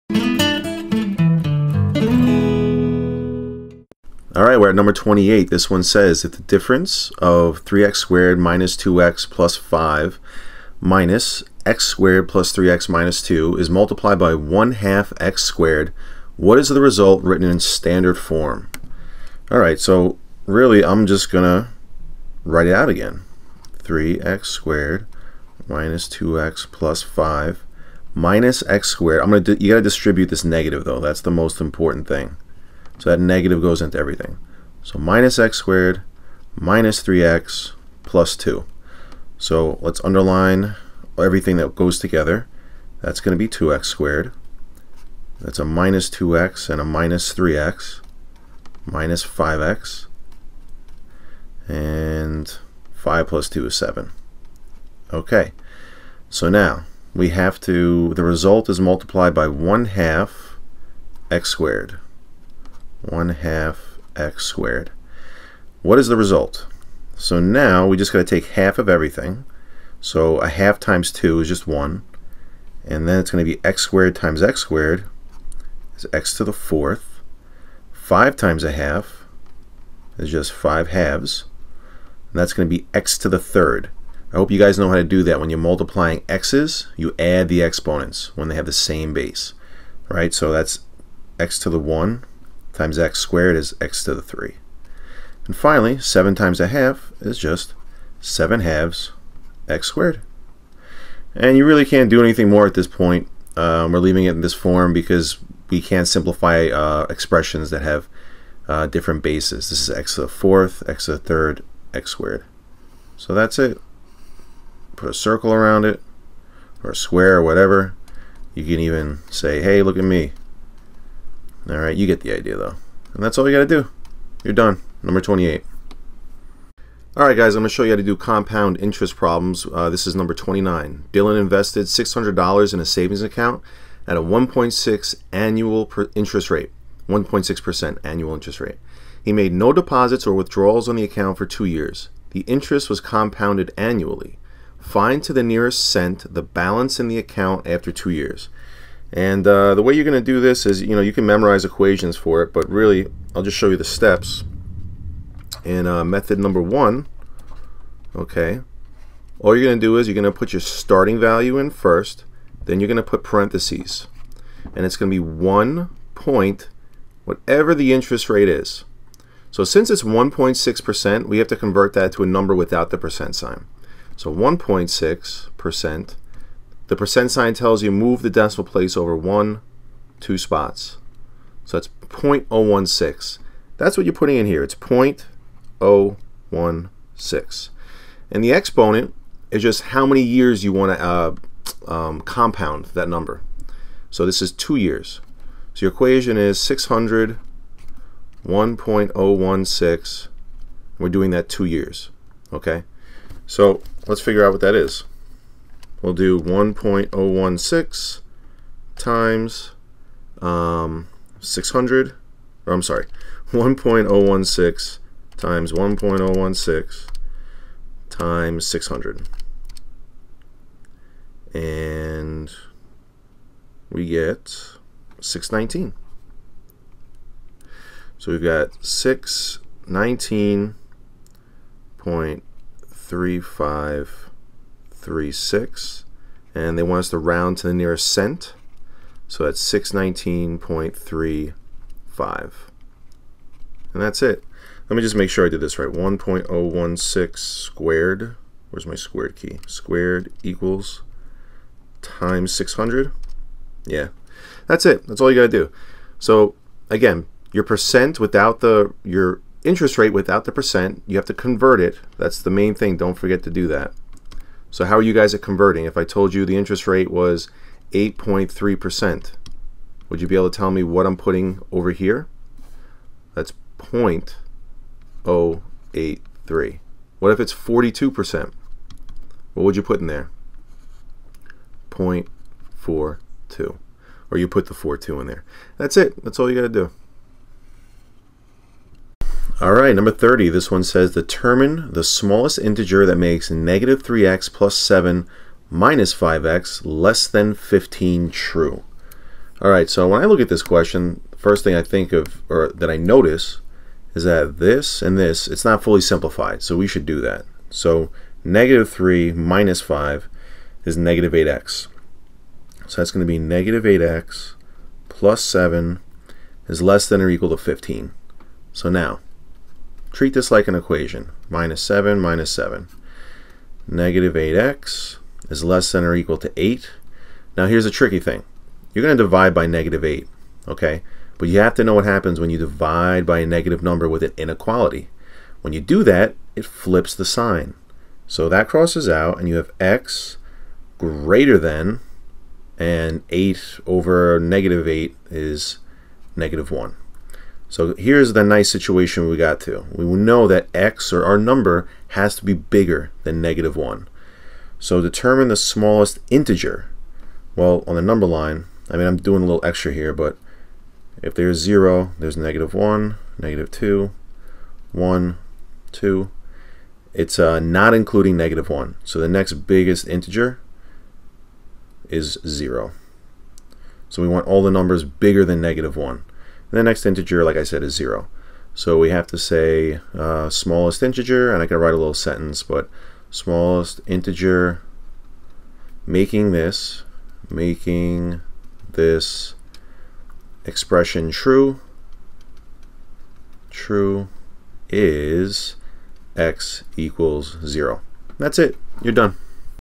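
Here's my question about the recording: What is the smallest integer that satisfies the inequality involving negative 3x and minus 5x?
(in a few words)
0.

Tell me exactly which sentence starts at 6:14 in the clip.
So we want all the numbers bigger than negative 1.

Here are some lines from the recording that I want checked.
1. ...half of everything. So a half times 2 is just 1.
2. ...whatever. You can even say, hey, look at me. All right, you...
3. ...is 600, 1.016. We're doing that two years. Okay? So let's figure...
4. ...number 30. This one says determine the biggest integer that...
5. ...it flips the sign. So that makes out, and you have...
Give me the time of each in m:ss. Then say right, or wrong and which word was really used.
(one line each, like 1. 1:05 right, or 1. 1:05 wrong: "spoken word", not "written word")
1. 1:08 right
2. 1:57 right
3. 3:16 right
4. 4:49 wrong: "smallest", not "biggest"
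5. 5:36 wrong: "crosses", not "makes".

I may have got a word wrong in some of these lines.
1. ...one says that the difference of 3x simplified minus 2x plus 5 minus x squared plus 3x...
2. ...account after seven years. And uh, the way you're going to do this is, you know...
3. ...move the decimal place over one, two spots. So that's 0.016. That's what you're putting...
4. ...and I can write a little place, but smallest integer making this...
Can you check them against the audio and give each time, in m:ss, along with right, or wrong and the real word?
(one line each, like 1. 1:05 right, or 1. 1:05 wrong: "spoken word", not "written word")
1. 0:05 wrong: "squared", not "simplified"
2. 2:27 wrong: "two", not "seven"
3. 2:57 right
4. 6:21 wrong: "sentence", not "place".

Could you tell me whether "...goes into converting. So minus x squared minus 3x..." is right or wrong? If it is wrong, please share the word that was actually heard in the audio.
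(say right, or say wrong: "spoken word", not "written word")
wrong: "everything", not "converting".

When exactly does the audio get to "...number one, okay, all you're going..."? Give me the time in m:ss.
2:36.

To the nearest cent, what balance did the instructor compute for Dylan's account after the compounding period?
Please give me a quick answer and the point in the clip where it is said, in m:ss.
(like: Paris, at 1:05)
$619.35, at 3:59.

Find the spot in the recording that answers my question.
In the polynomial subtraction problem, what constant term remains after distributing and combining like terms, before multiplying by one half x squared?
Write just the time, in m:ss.
0:52.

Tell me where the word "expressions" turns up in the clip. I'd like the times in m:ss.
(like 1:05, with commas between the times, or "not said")
1:47, 6:30.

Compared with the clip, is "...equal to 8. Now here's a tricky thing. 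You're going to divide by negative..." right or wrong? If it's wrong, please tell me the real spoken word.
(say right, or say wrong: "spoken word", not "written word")
right.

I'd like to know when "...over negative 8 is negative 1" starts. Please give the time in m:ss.
5:43.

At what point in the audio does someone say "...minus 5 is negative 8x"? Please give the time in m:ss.
5:09.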